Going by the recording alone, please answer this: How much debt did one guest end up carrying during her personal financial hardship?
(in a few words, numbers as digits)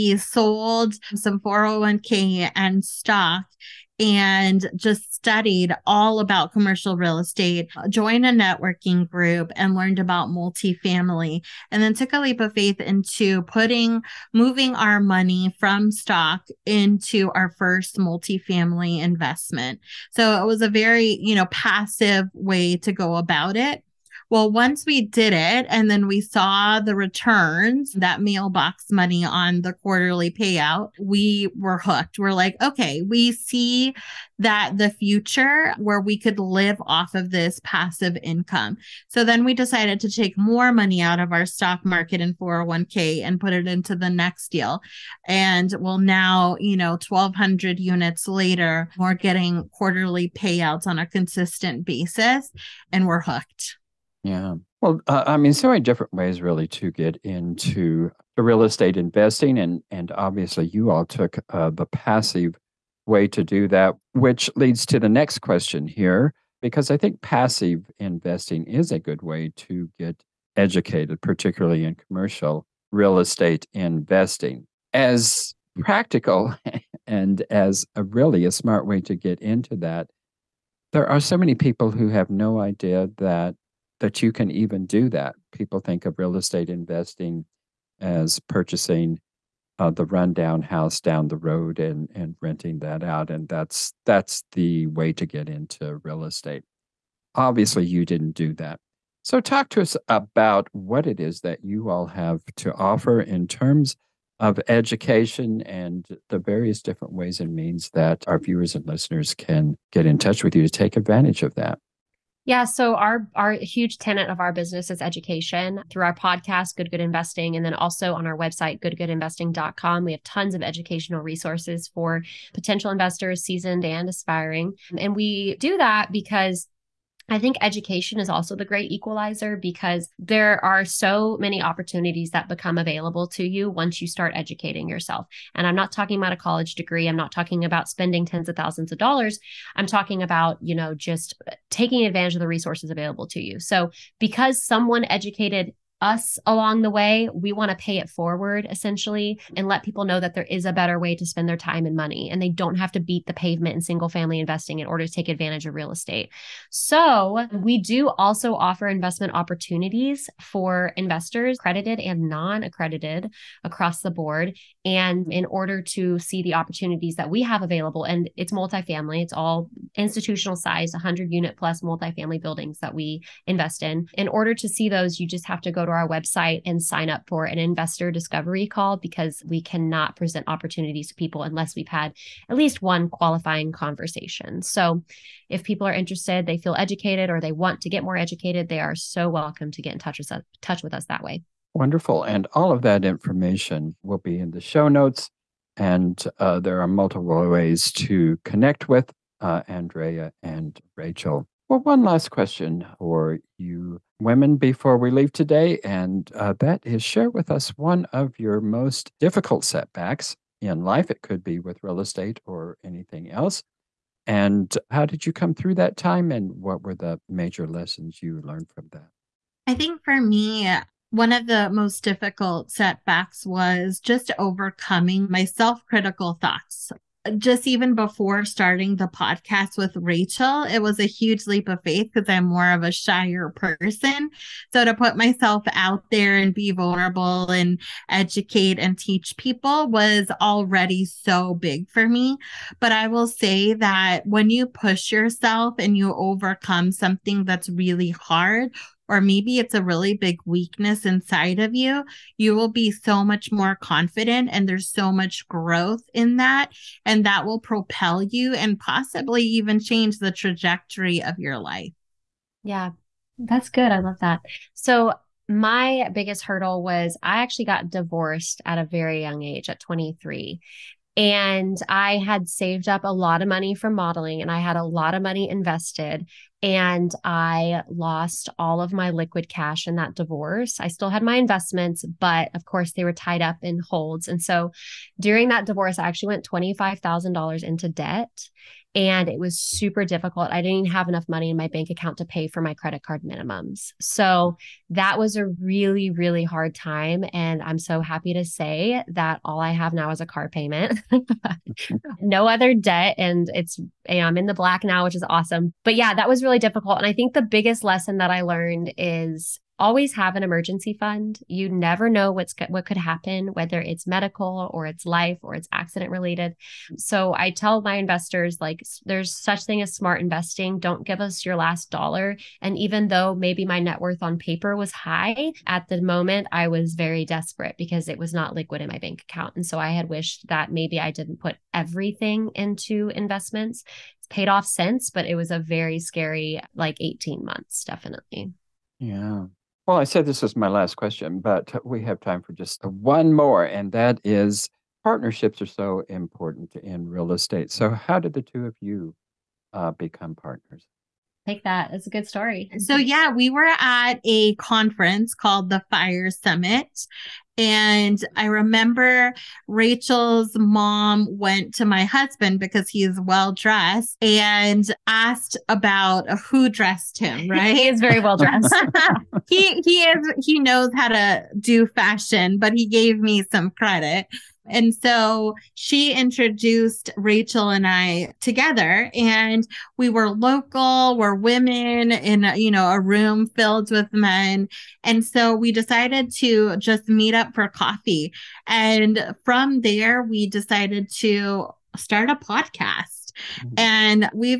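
$25,000.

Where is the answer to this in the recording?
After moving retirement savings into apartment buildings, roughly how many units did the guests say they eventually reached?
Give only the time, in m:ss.
0:47.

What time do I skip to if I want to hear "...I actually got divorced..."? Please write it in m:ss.
4:27.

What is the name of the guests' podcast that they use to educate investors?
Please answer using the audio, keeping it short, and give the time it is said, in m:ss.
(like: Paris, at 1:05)
Good Good Investing, at 1:56.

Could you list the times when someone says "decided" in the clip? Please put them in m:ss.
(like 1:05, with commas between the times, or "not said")
0:39, 6:25, 6:30.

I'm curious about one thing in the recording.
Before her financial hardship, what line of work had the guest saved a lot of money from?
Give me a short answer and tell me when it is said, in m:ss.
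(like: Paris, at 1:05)
Modeling, at 4:33.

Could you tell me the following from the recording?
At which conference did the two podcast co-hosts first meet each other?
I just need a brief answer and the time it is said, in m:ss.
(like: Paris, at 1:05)
Fire Summit, at 5:55.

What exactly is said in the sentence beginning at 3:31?
It could be with real estate or anything else.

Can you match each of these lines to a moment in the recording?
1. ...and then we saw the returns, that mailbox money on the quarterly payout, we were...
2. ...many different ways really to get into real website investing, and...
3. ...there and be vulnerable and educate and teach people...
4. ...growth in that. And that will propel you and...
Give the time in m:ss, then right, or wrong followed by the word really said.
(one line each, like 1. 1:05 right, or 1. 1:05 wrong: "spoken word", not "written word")
1. 0:25 right
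2. 0:55 wrong: "estate", not "website"
3. 3:56 right
4. 4:15 right.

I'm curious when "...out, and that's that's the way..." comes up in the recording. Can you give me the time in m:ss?
1:33.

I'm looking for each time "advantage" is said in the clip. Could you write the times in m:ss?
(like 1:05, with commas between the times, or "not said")
1:50, 2:22, 2:35.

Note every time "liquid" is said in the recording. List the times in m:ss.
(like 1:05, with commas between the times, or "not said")
4:39, 5:28.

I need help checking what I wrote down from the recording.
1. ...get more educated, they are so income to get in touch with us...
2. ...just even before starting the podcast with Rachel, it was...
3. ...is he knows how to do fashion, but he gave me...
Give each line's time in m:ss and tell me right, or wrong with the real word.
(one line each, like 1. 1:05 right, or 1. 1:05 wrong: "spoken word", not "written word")
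1. 3:07 wrong: "welcome", not "income"
2. 3:47 right
3. 6:10 right.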